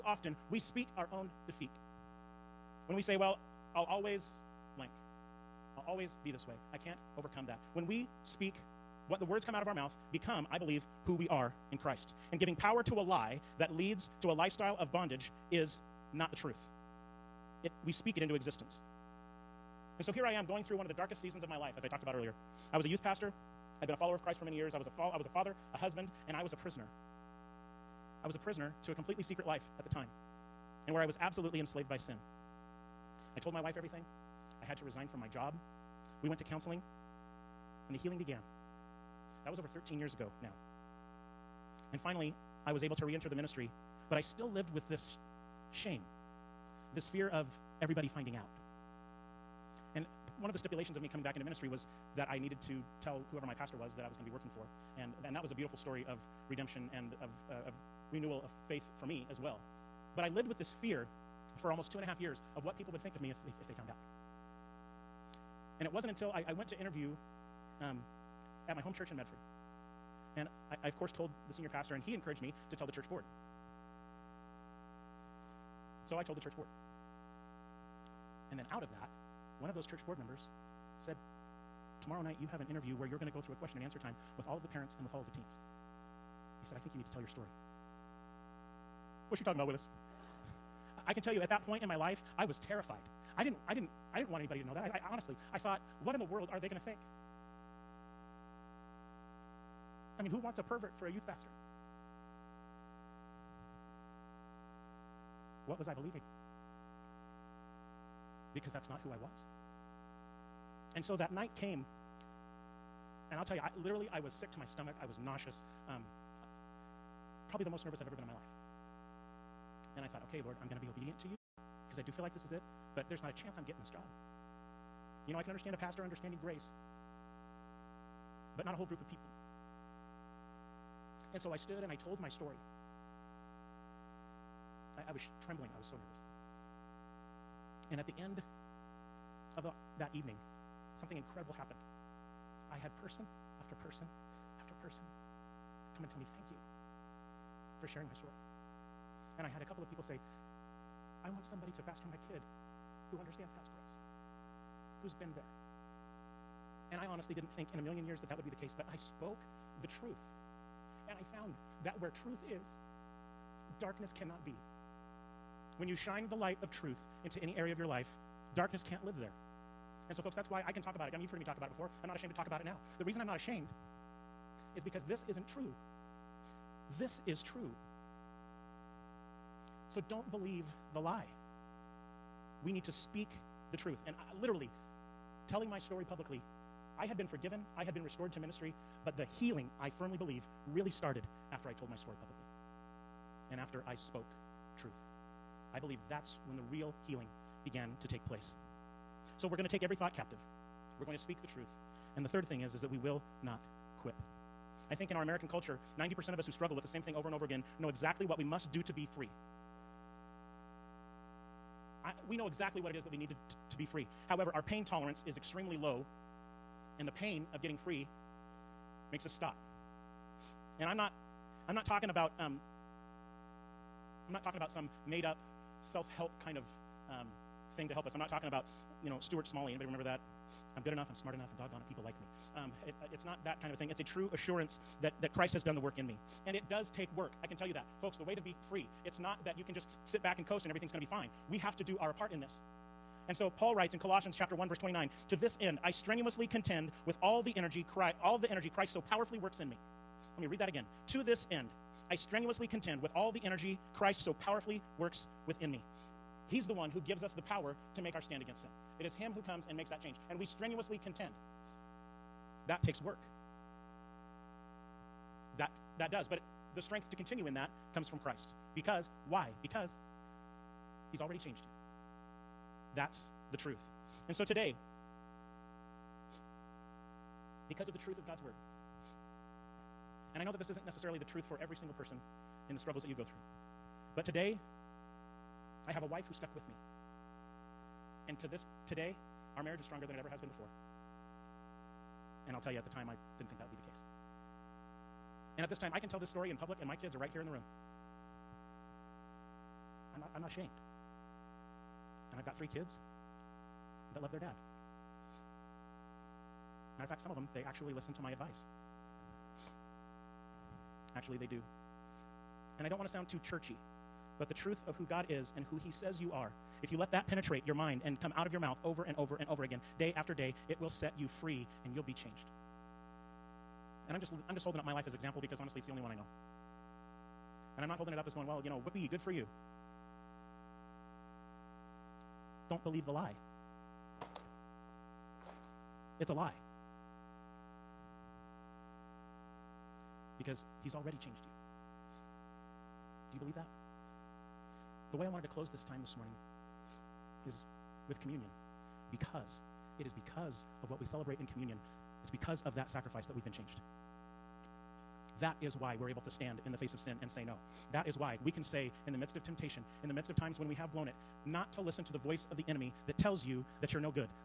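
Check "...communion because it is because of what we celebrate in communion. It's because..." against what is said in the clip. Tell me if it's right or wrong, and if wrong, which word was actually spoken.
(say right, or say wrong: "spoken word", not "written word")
right.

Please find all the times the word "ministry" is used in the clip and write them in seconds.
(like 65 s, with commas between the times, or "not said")
43 s, 51 s, 188 s.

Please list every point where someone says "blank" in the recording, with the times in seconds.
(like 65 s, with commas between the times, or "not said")
4 s.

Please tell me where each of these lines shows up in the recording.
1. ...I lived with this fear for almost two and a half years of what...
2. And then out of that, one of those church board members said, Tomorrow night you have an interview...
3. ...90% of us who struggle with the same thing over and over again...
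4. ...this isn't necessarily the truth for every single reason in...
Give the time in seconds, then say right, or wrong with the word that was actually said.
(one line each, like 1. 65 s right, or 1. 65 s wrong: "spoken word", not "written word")
1. 60 s right
2. 78 s right
3. 205 s right
4. 280 s wrong: "person", not "reason".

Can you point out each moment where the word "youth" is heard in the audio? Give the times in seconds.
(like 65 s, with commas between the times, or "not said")
22 s, 101 s.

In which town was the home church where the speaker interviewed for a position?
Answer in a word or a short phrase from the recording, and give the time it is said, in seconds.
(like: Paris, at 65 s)
Medford, at 69 s.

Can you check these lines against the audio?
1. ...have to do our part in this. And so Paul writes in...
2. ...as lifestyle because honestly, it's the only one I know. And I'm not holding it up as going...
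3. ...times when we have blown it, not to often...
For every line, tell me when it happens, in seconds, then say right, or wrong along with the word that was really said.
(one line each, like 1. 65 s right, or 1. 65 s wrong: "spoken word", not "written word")
1. 241 s right
2. 325 s wrong: "example", not "lifestyle"
3. 360 s wrong: "listen", not "often".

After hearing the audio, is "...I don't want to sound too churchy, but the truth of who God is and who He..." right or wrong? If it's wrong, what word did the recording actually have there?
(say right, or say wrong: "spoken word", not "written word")
right.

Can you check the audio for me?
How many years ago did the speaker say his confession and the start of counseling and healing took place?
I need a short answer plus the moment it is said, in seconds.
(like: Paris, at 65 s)
13, at 39 s.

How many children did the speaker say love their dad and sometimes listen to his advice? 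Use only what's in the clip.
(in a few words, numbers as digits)
3.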